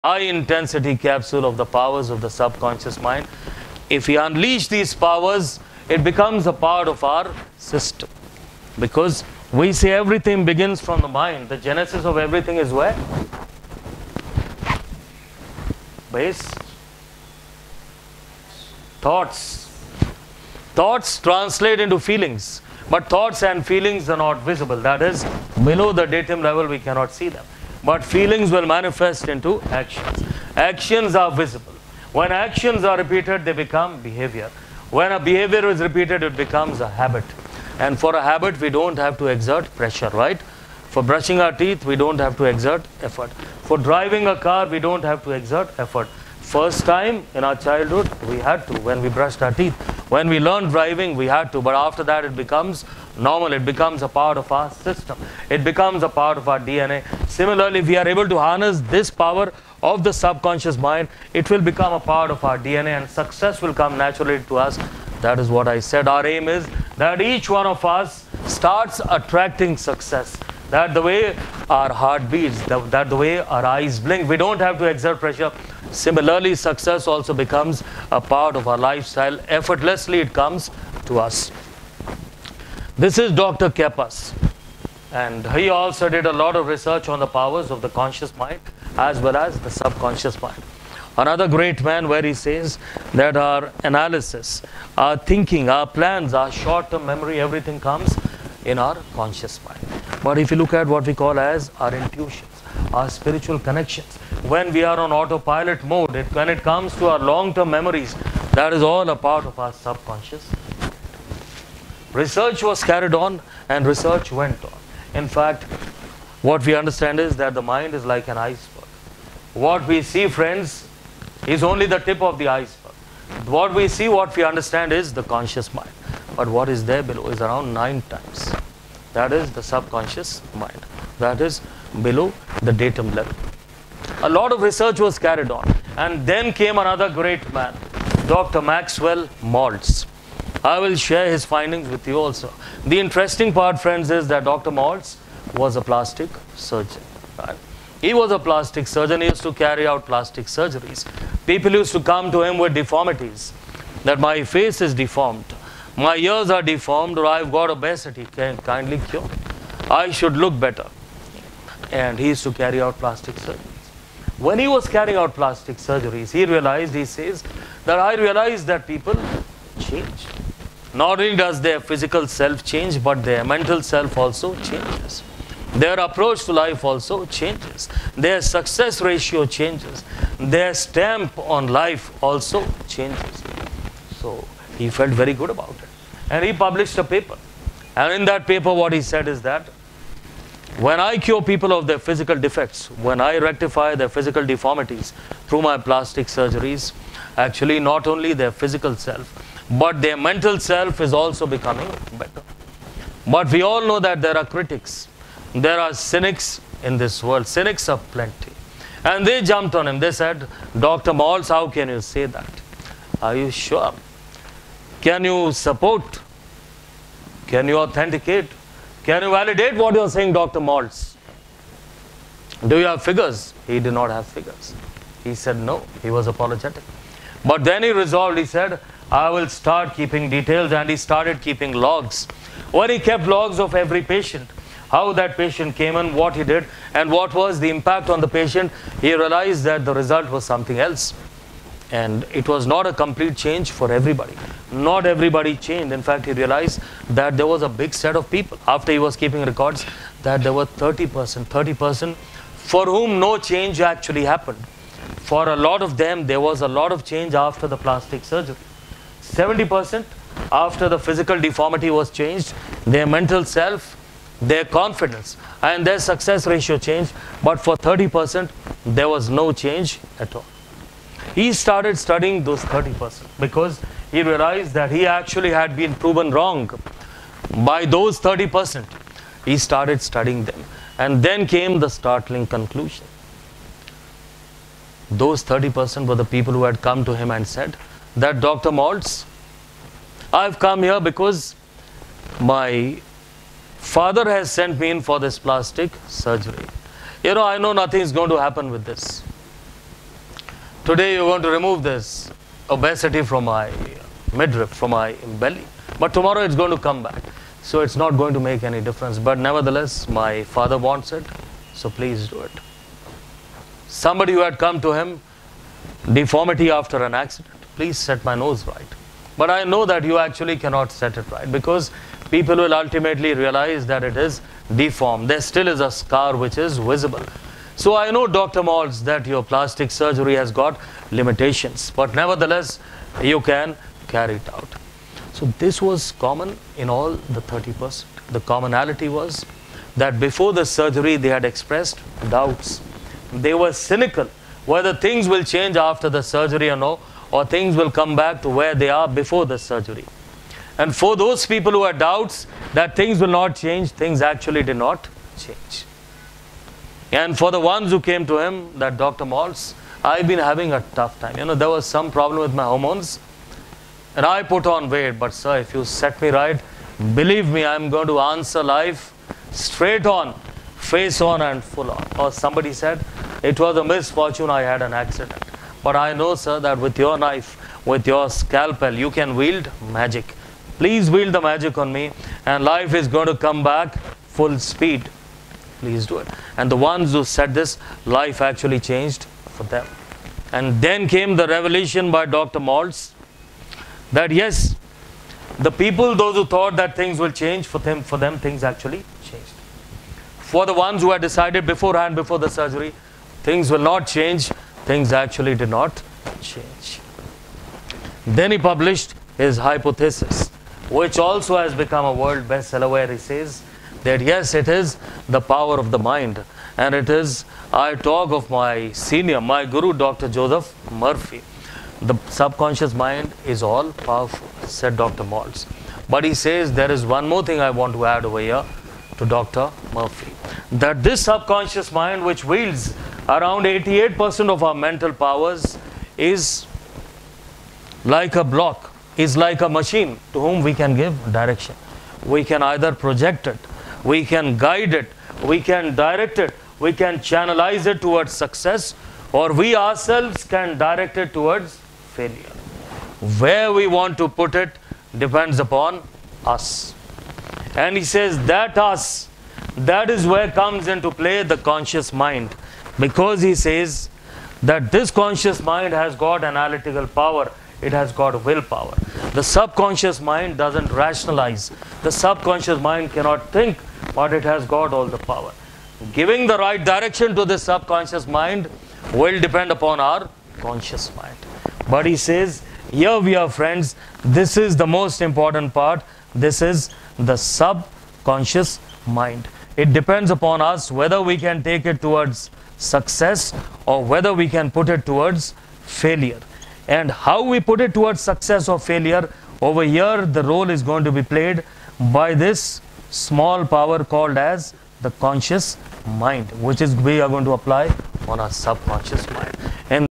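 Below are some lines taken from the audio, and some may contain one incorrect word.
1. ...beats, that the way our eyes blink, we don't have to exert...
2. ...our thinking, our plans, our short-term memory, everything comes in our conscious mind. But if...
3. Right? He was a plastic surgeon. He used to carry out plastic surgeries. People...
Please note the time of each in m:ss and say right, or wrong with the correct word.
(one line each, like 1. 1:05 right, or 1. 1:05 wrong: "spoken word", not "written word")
1. 1:12 right
2. 1:34 right
3. 2:27 right.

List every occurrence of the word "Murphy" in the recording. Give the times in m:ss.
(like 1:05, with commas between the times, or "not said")
7:00, 7:09.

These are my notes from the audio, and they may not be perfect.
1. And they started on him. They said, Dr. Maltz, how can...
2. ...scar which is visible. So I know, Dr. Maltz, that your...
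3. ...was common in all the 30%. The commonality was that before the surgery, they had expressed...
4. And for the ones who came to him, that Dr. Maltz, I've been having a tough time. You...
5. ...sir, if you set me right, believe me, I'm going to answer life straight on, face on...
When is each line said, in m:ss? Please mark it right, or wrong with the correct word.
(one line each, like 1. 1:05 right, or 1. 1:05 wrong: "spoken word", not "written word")
1. 3:29 wrong: "jumped", not "started"
2. 5:25 right
3. 5:35 right
4. 5:57 right
5. 6:05 right.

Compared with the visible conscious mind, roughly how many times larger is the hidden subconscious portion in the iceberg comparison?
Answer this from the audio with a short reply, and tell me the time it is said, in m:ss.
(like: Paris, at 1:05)
9 times, at 2:07.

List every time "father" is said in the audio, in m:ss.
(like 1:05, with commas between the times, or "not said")
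4:53, 5:10.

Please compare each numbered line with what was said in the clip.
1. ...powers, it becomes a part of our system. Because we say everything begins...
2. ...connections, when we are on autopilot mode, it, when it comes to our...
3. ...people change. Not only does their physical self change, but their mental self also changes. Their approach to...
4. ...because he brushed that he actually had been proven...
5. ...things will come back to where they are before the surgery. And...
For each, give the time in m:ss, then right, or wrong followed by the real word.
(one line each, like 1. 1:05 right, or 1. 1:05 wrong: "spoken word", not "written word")
1. 0:04 right
2. 1:43 right
3. 2:48 right
4. 4:33 wrong: "realized", not "brushed"
5. 5:47 right.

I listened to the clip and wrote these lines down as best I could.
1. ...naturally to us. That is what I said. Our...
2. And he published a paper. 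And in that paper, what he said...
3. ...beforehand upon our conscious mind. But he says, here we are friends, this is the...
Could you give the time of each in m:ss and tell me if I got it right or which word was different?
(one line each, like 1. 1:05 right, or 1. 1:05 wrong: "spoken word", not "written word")
1. 1:03 right
2. 3:06 right
3. 7:59 wrong: "depend", not "beforehand".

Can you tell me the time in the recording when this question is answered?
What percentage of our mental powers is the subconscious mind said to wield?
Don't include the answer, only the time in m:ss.
7:13.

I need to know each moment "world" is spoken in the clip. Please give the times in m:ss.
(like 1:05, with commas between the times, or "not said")
3:27, 6:52.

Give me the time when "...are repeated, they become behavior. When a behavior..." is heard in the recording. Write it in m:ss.
0:32.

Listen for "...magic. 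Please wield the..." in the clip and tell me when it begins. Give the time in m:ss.
6:19.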